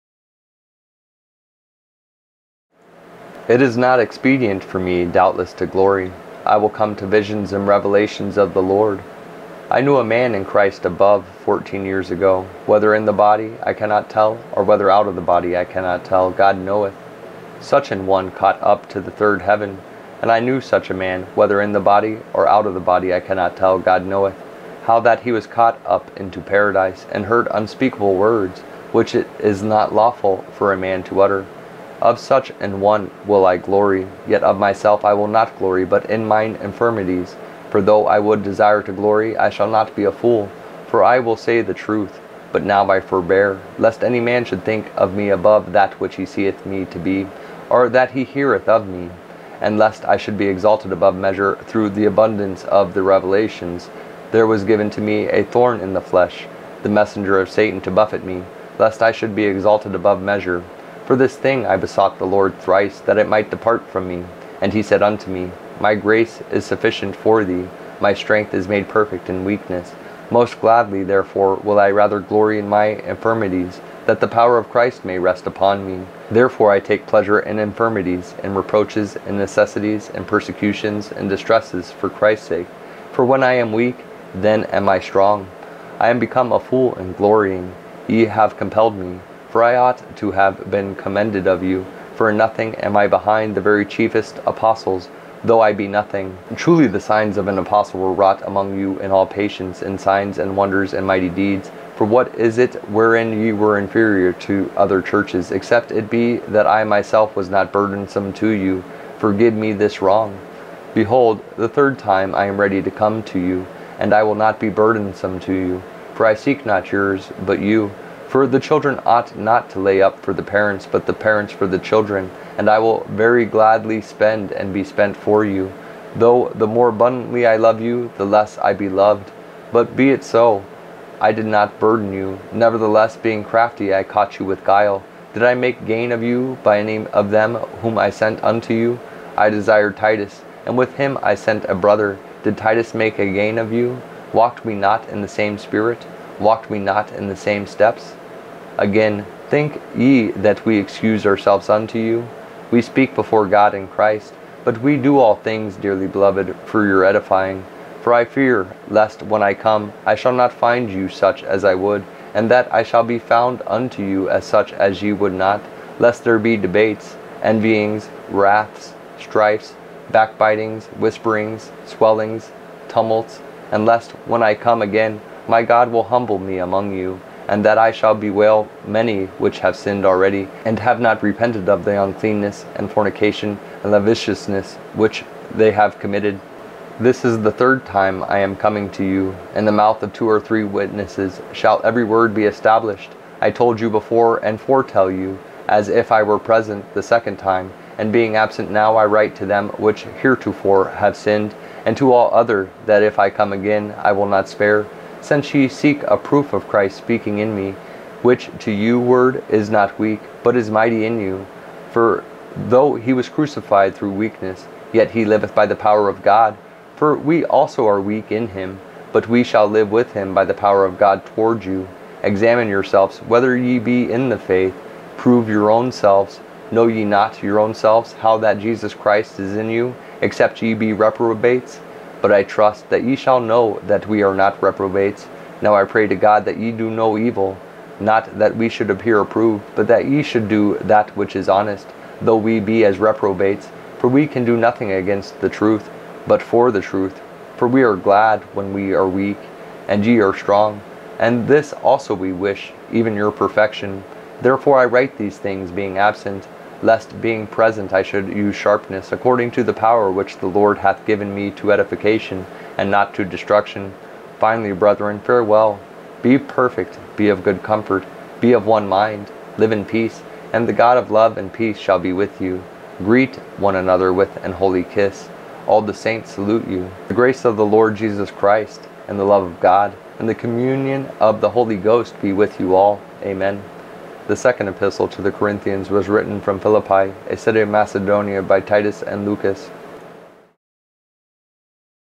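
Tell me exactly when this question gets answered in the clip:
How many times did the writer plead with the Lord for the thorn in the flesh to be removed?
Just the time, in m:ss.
1:02.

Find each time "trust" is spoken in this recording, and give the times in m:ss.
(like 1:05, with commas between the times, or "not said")
3:52.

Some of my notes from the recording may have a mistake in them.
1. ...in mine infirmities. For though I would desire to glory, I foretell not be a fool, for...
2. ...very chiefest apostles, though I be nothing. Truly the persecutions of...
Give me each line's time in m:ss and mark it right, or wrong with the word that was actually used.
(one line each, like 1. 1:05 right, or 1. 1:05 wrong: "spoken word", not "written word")
1. 0:36 wrong: "shall", not "foretell"
2. 1:33 wrong: "signs", not "persecutions".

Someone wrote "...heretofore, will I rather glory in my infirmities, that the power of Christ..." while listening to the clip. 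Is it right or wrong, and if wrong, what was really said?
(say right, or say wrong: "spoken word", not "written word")
wrong: "therefore", not "heretofore".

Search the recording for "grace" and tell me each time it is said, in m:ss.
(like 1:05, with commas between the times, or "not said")
1:05, 4:37.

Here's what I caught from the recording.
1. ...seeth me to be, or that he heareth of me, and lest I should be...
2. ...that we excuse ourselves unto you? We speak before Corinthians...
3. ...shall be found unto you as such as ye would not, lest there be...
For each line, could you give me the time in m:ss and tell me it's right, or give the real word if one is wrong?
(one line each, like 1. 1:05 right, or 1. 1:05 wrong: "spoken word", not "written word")
1. 0:46 right
2. 2:30 wrong: "God", not "Corinthians"
3. 2:42 right.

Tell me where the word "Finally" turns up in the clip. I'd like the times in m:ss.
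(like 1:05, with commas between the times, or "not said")
4:24.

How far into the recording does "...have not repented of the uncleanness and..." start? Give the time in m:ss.
3:00.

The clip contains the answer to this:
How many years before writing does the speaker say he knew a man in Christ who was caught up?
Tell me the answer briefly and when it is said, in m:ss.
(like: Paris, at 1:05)
14, at 0:11.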